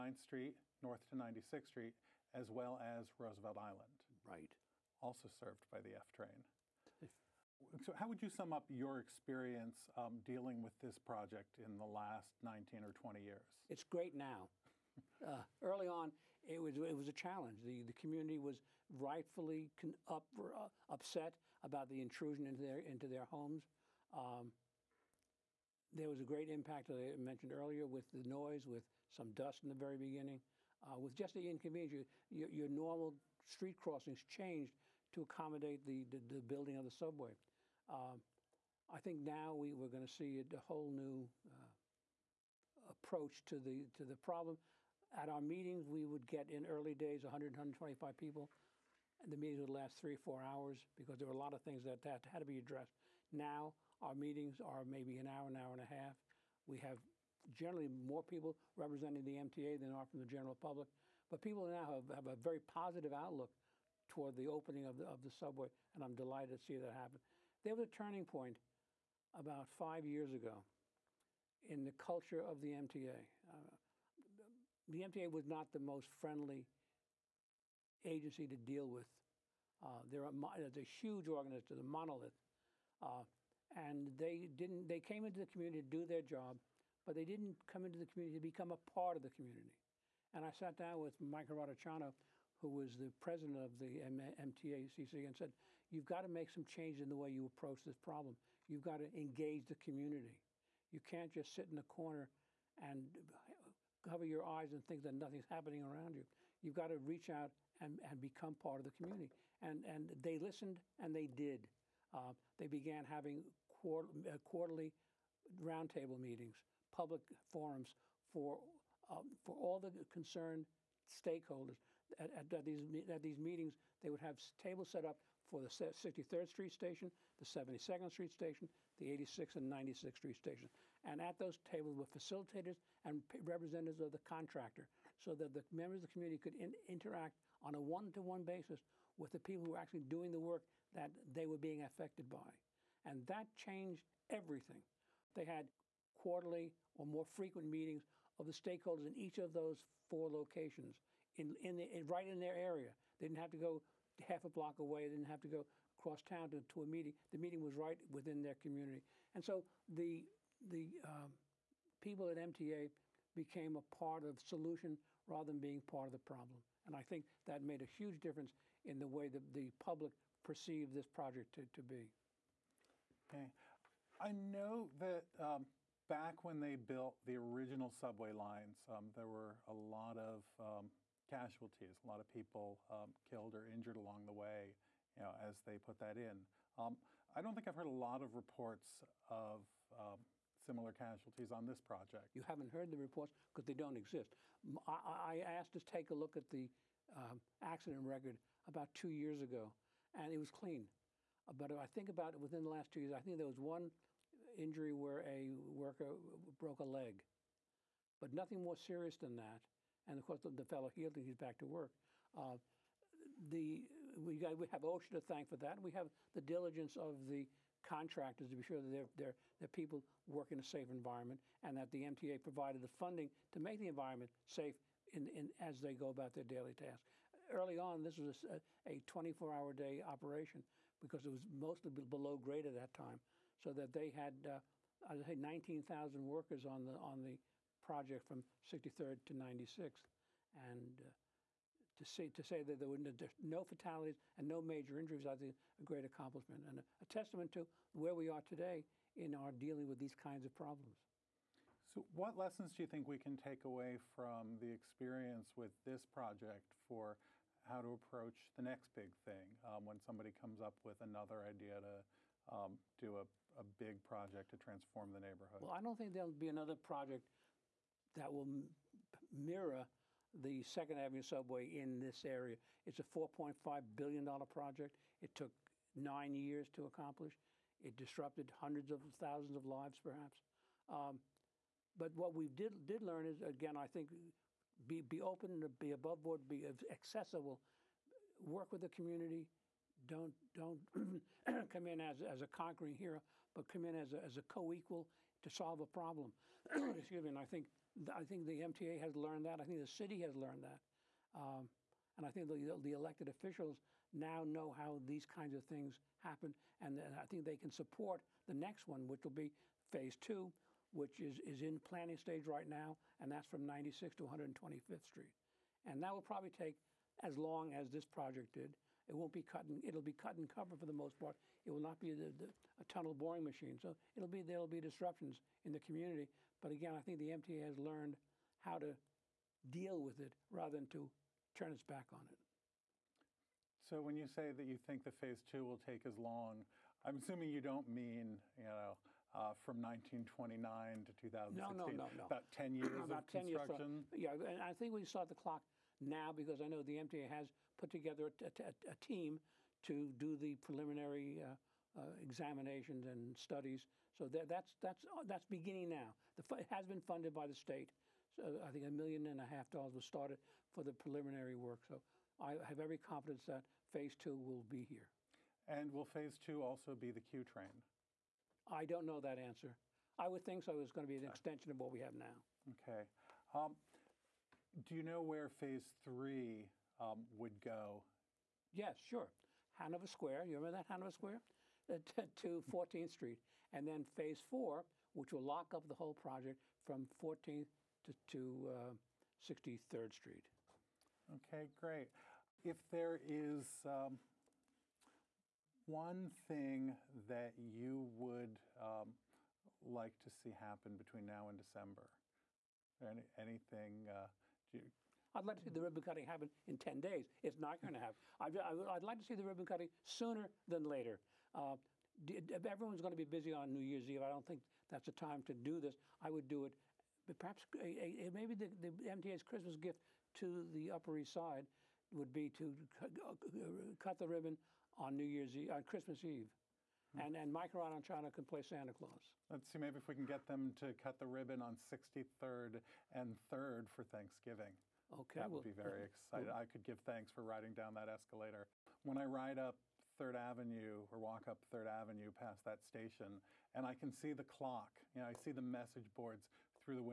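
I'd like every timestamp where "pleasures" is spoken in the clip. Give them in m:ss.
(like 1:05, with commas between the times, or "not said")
not said.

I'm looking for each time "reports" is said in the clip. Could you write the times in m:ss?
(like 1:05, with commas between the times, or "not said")
3:08, 3:12.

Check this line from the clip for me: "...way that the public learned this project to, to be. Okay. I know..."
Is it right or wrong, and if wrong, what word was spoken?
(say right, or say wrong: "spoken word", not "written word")
wrong: "perceived", not "learned".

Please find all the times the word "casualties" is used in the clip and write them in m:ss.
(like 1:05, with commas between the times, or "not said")
3:01, 3:10.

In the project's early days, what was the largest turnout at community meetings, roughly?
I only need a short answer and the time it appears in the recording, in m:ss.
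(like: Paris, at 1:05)
125, at 0:47.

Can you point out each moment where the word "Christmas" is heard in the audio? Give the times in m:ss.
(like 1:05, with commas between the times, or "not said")
6:59, 7:05.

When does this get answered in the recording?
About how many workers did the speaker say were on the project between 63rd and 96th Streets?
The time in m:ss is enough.
3:55.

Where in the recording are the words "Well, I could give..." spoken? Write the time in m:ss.
7:16.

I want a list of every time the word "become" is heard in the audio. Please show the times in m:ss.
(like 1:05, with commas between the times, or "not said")
1:28, 1:48.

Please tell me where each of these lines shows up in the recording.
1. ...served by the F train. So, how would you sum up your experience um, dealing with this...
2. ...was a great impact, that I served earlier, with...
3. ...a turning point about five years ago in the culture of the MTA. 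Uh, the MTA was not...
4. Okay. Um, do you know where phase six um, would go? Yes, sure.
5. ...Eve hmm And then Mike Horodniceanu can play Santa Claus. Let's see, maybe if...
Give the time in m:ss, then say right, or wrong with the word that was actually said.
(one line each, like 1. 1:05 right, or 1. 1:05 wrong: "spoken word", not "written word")
1. 0:05 right
2. 0:26 wrong: "mentioned", not "served"
3. 1:07 right
4. 6:12 wrong: "three", not "six"
5. 7:06 right.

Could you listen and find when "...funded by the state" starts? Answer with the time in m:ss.
5:57.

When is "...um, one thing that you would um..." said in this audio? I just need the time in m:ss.
6:33.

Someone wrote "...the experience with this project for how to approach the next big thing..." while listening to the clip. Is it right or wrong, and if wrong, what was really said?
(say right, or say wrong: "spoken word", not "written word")
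right.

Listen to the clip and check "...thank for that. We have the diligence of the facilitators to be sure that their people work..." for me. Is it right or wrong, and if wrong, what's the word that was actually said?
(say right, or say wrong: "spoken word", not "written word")
wrong: "contractors", not "facilitators".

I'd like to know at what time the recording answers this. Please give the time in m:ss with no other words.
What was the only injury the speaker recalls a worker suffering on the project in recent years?
3:26.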